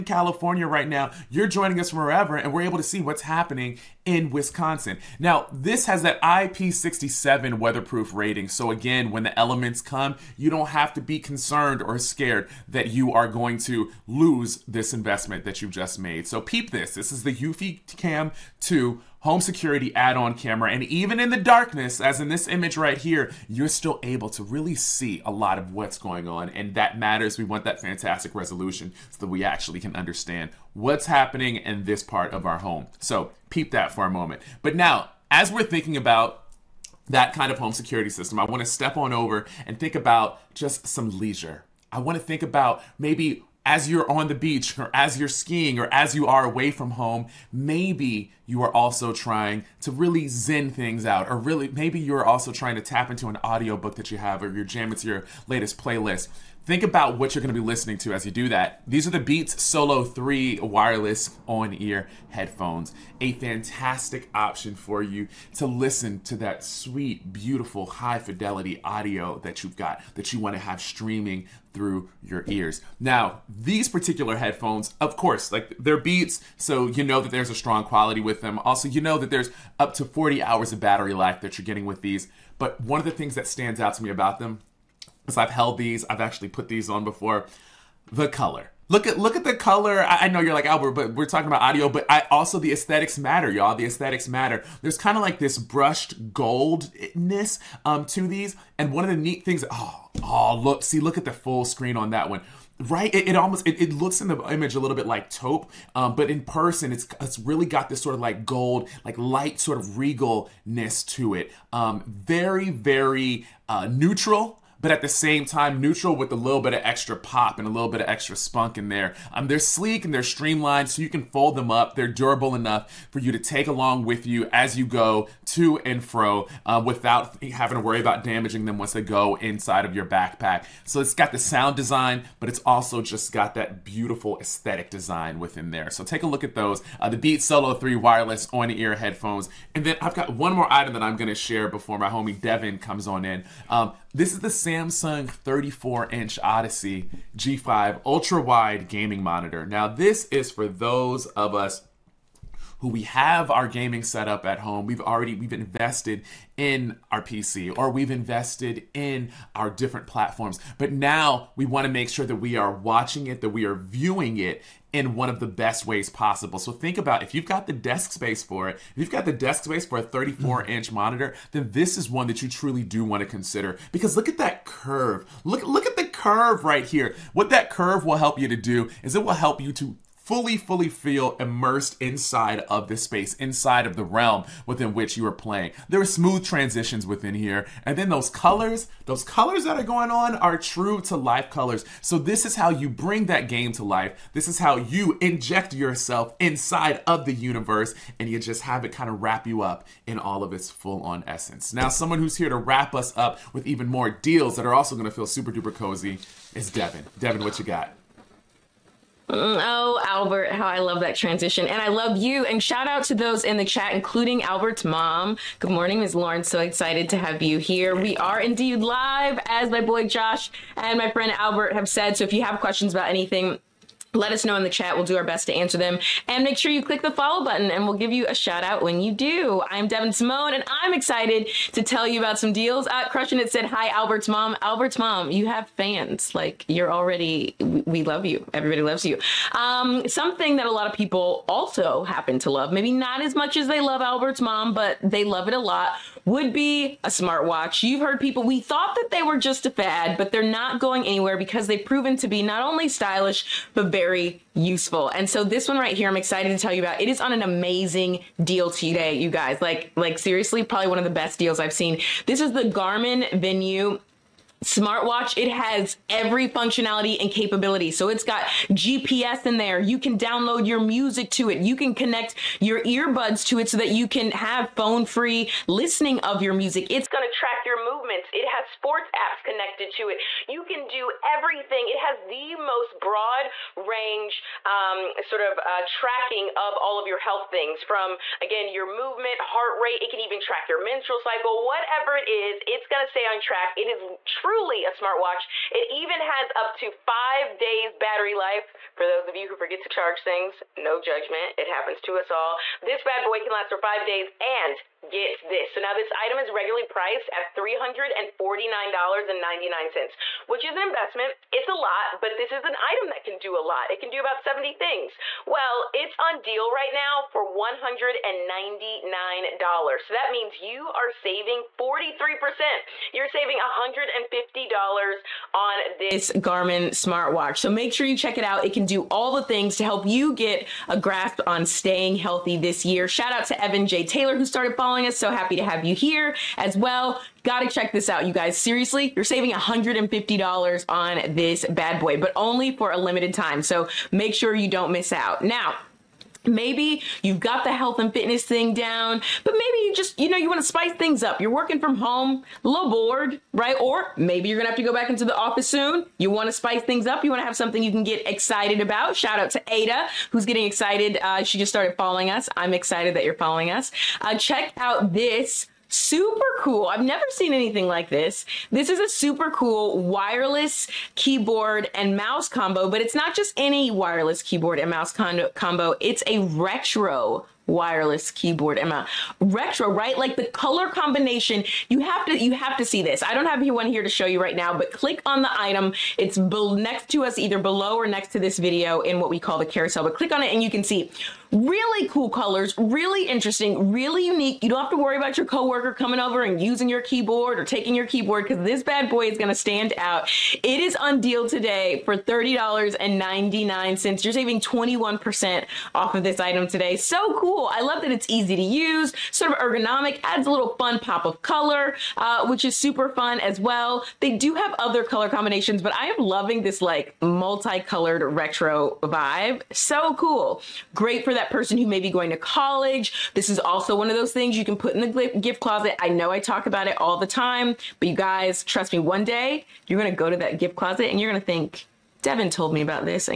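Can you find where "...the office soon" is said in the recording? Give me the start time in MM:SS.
05:55.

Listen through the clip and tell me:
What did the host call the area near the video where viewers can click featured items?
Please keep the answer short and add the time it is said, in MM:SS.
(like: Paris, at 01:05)
the carousel, at 06:29.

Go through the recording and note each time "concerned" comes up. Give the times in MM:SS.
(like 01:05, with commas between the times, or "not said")
00:11.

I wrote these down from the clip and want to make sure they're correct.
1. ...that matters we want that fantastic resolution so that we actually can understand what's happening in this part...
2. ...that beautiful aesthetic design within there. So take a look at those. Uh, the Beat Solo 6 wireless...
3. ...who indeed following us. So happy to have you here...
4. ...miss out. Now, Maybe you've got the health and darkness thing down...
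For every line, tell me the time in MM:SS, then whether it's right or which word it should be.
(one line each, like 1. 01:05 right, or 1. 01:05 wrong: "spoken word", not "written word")
1. 00:26 right
2. 02:13 wrong: "3", not "6"
3. 05:34 wrong: "started", not "indeed"
4. 05:44 wrong: "fitness", not "darkness".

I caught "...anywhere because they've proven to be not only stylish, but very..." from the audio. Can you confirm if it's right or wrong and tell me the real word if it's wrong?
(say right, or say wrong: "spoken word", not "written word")
right.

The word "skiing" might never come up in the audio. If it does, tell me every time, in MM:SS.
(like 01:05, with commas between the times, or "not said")
00:45.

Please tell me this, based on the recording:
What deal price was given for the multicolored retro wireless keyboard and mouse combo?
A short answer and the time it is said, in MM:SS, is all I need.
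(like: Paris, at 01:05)
$30.99, at 06:42.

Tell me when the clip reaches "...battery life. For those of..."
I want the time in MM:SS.
04:57.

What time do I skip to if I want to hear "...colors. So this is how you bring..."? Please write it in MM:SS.
03:11.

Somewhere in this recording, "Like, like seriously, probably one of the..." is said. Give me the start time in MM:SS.
04:19.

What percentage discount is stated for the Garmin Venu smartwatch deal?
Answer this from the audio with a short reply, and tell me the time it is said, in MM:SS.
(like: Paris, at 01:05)
43%, at 05:21.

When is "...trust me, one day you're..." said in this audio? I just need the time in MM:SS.
07:08.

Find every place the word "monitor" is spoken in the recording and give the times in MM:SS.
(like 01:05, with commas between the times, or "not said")
02:29, 02:50.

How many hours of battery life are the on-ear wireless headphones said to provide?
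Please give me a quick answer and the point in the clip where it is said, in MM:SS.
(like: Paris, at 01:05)
40 hours, at 01:20.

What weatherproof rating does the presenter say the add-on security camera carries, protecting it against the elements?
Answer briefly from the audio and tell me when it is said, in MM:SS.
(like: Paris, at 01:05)
IP67, at 00:06.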